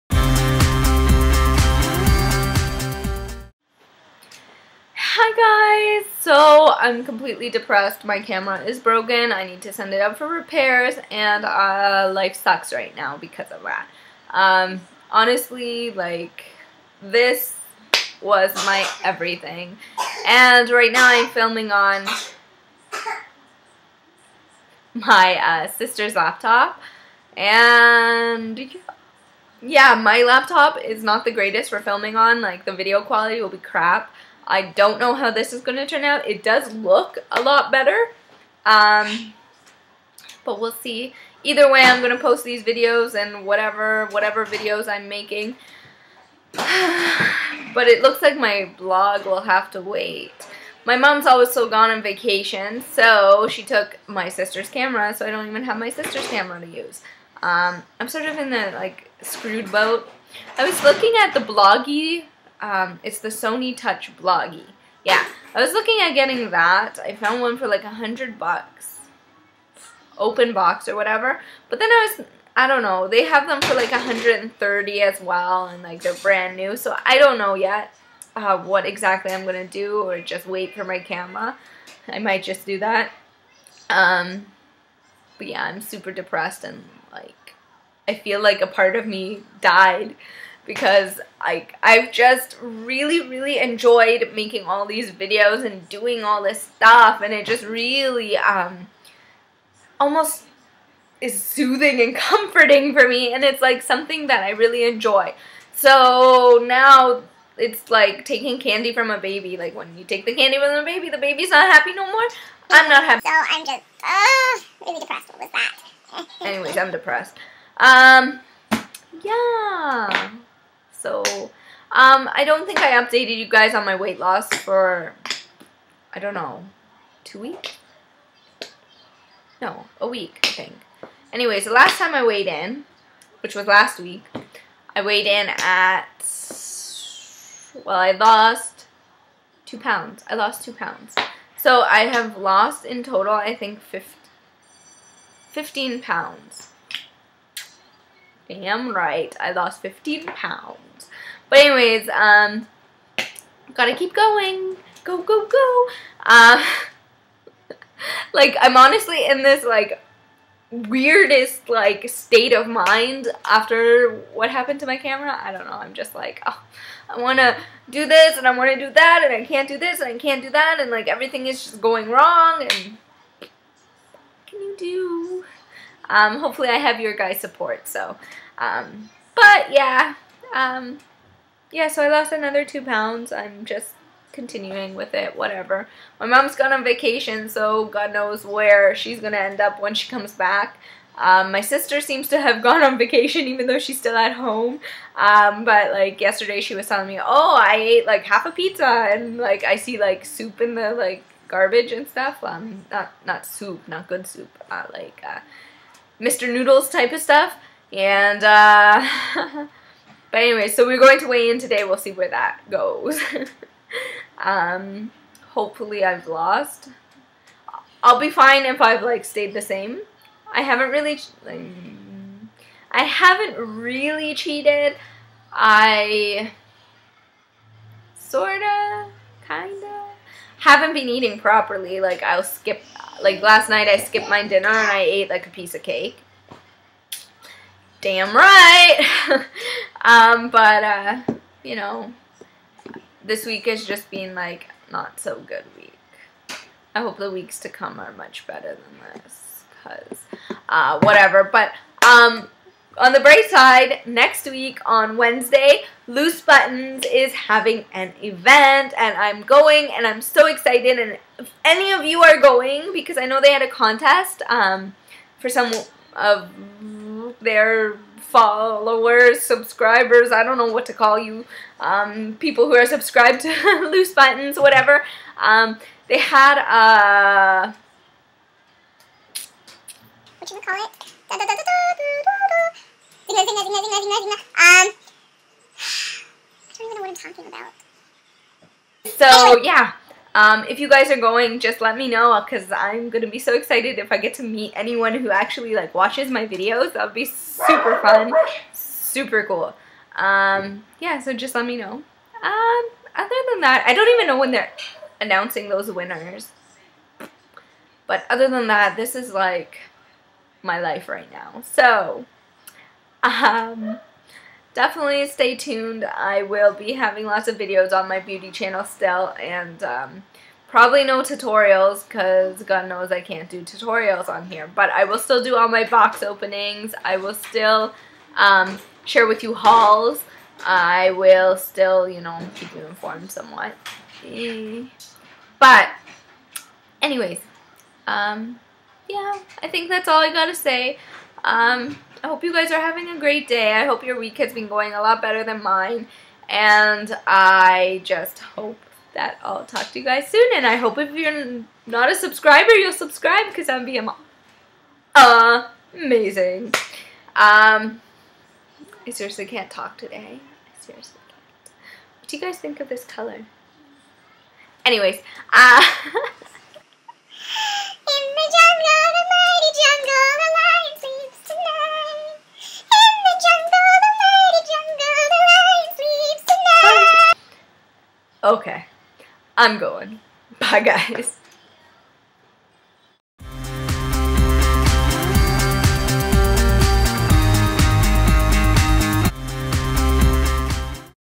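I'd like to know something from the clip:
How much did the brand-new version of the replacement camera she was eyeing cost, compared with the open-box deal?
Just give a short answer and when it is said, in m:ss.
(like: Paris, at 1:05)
130, at 1:13.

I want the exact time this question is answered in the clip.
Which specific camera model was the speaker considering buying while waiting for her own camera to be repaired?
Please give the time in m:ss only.
1:03.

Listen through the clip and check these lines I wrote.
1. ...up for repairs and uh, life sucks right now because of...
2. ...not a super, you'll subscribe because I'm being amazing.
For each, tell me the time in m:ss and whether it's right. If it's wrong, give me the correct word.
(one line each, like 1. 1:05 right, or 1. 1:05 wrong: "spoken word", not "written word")
1. 0:10 right
2. 5:51 wrong: "subscriber", not "super".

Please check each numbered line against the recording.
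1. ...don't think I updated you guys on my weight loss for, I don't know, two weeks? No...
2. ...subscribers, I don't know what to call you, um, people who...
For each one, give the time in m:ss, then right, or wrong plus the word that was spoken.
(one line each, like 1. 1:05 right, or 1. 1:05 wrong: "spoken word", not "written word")
1. 2:02 right
2. 4:29 right.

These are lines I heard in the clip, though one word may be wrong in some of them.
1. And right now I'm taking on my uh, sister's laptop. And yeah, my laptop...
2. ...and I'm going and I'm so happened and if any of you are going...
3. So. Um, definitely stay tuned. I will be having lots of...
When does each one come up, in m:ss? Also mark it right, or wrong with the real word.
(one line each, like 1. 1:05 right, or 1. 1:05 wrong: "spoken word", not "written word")
1. 0:20 wrong: "filming", not "taking"
2. 4:18 wrong: "excited", not "happened"
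3. 5:11 right.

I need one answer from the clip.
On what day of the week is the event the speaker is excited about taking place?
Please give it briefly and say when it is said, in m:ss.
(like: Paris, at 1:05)
Wednesday, at 4:15.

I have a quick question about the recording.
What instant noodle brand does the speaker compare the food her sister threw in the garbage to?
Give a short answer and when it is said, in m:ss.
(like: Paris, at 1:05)
Mr. Noodles, at 3:26.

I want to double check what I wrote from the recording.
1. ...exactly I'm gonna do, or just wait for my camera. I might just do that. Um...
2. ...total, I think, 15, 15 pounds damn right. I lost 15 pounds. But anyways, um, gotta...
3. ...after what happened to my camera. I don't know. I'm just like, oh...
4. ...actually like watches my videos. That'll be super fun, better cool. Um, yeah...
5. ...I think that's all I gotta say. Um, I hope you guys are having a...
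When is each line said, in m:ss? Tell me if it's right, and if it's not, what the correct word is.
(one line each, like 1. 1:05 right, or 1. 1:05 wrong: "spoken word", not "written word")
1. 1:18 right
2. 2:23 right
3. 2:43 right
4. 4:55 wrong: "super", not "better"
5. 5:39 right.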